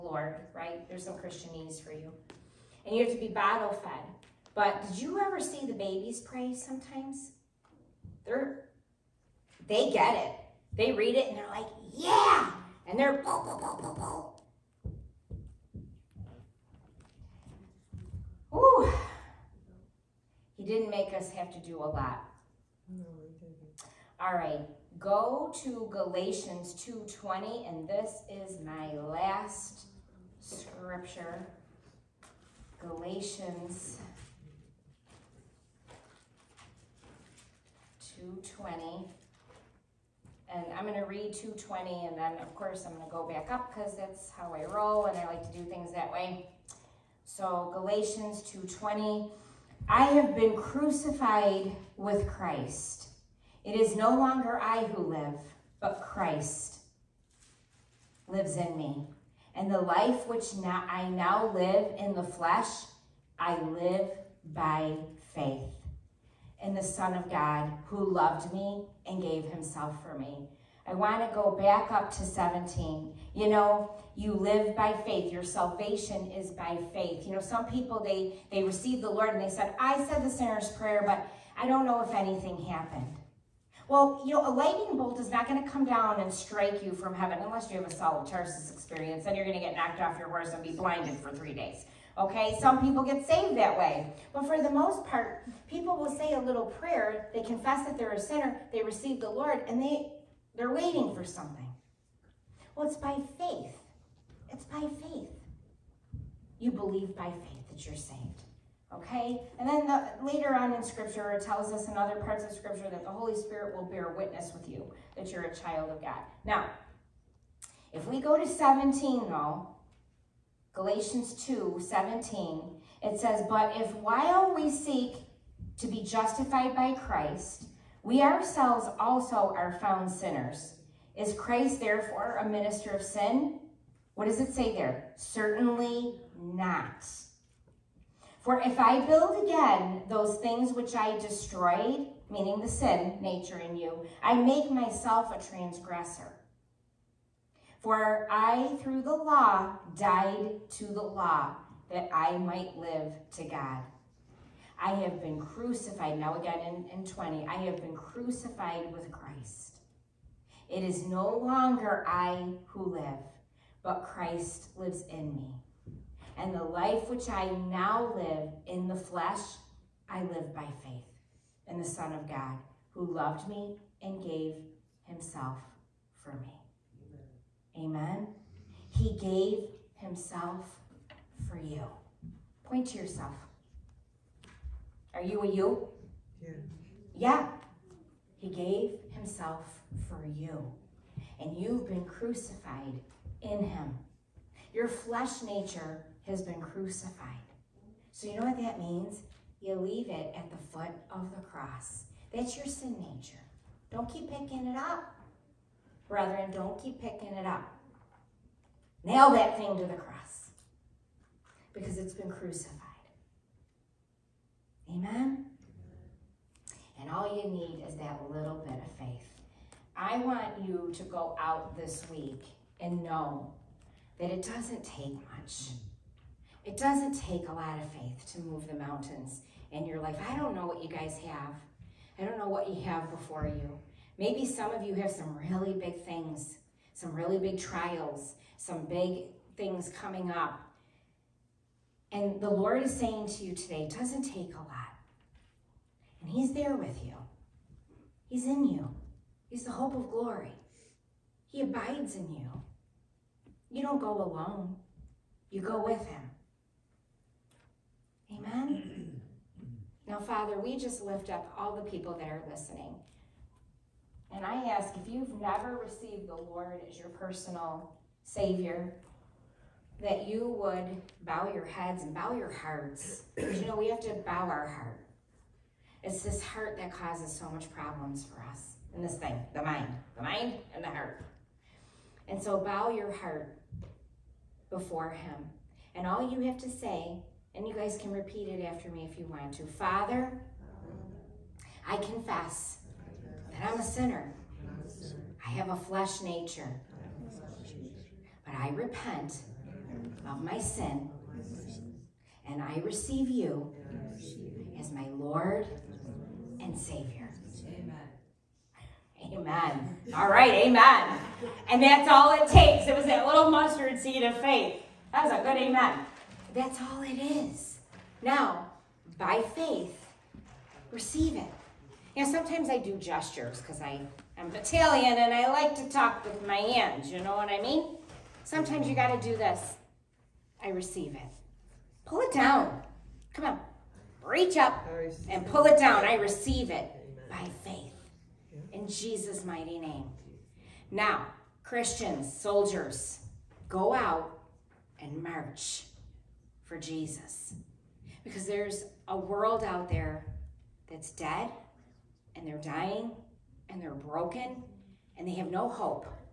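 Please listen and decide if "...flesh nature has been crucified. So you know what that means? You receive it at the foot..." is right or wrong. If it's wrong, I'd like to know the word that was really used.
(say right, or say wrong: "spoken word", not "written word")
wrong: "leave", not "receive".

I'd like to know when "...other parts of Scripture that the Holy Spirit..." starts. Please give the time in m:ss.
1:51.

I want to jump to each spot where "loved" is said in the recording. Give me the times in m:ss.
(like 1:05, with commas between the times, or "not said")
1:08, 2:53.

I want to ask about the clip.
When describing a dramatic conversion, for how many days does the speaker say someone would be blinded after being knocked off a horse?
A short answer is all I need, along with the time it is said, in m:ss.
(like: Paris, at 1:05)
3, at 1:31.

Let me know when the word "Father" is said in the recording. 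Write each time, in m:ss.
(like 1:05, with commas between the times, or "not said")
4:20, 4:49.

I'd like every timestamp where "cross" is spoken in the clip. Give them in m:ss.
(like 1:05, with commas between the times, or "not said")
3:21, 3:29.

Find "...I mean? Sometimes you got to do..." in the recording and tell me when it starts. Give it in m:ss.
5:27.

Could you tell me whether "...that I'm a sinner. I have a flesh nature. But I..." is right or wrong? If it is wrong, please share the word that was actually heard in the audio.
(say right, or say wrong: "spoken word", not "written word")
right.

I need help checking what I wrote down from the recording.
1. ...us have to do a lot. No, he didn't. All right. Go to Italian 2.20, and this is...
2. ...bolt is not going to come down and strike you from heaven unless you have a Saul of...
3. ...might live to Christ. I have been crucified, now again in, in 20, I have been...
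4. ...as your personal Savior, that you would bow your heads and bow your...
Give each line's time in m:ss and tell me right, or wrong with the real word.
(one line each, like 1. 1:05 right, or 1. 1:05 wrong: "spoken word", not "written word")
1. 0:21 wrong: "Galatians", not "Italian"
2. 1:24 right
3. 2:32 wrong: "God", not "Christ"
4. 4:26 right.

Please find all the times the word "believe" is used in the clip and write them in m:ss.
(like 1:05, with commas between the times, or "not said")
1:46.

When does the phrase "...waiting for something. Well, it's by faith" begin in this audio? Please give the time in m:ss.
1:40.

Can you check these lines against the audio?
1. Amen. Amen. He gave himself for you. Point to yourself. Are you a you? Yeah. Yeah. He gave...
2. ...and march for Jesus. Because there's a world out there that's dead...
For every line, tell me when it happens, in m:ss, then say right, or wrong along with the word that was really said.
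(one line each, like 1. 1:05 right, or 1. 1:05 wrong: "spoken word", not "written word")
1. 2:57 right
2. 5:44 right.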